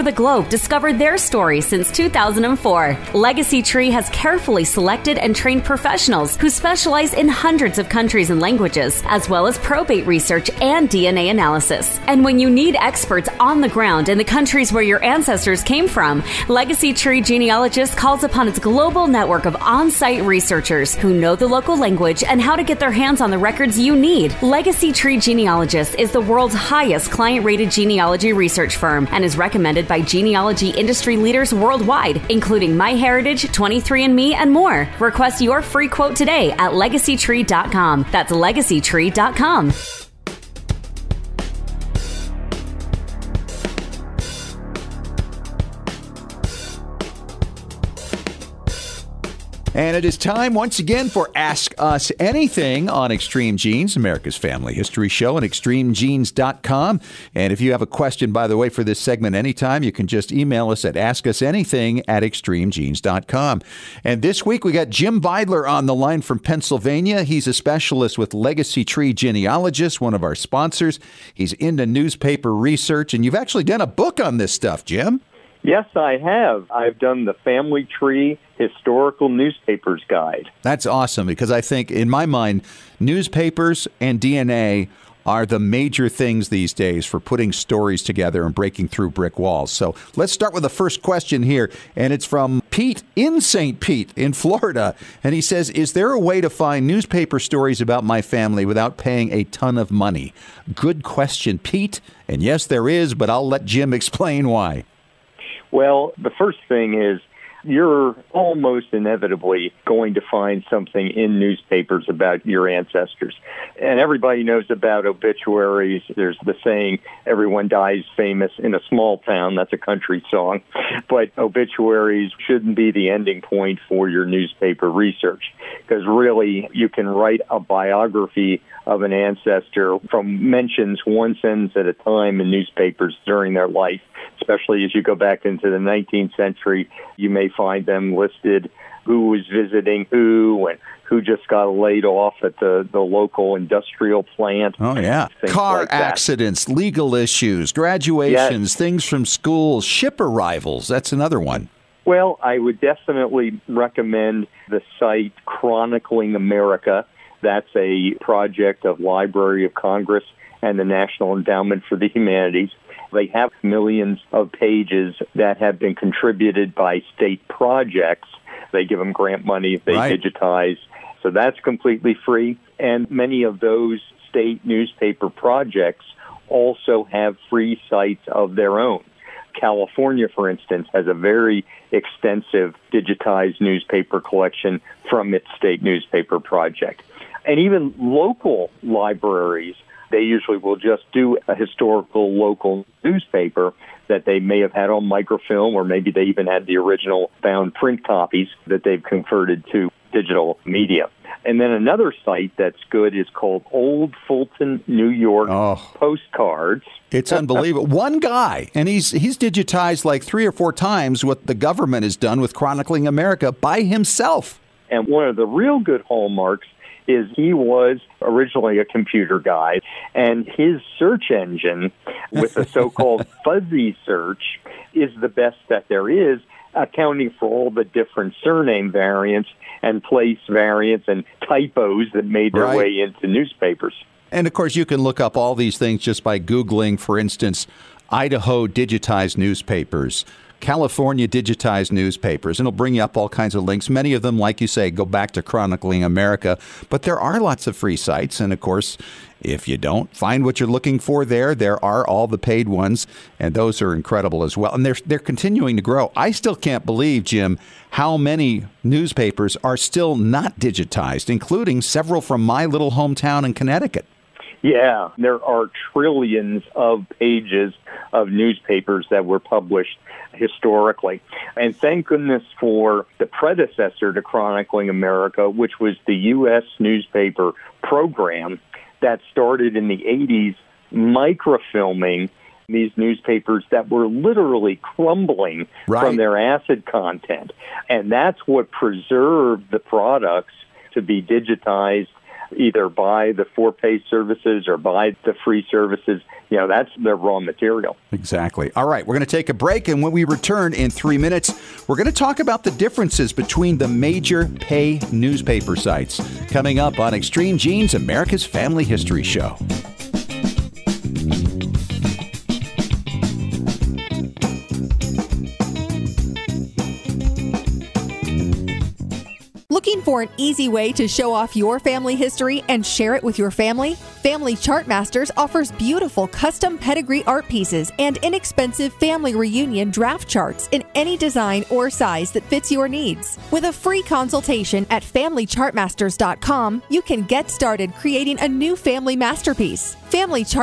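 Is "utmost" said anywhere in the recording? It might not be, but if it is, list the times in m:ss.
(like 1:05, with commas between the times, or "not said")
not said.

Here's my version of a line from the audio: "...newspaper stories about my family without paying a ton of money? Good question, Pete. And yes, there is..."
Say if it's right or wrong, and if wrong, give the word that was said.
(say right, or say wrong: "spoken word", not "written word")
right.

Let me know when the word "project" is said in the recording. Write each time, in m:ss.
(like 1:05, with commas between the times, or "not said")
2:38, 2:47, 2:55, 3:06.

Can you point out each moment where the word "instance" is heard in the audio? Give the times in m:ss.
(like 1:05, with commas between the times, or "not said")
3:00, 3:57.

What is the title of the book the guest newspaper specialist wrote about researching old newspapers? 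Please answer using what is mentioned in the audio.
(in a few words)
Family Tree Historical Newspapers Guide.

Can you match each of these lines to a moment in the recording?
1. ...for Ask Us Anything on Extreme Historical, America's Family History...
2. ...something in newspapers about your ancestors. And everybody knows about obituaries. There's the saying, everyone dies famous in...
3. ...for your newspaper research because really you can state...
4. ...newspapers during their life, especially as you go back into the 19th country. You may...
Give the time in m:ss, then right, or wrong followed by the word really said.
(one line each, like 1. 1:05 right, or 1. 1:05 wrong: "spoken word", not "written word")
1. 0:51 wrong: "Genes", not "Historical"
2. 1:50 right
3. 2:03 wrong: "write", not "state"
4. 2:12 wrong: "century", not "country".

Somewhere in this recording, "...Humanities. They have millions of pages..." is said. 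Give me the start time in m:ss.
2:42.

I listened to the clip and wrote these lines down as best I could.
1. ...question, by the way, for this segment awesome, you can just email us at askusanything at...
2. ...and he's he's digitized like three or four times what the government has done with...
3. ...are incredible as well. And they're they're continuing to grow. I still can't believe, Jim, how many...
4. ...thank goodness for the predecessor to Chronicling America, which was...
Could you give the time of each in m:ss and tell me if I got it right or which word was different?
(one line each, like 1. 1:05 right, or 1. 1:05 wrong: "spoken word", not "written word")
1. 0:57 wrong: "anytime", not "awesome"
2. 3:28 right
3. 4:13 right
4. 4:31 right.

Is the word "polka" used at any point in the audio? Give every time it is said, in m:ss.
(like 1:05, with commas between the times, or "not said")
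not said.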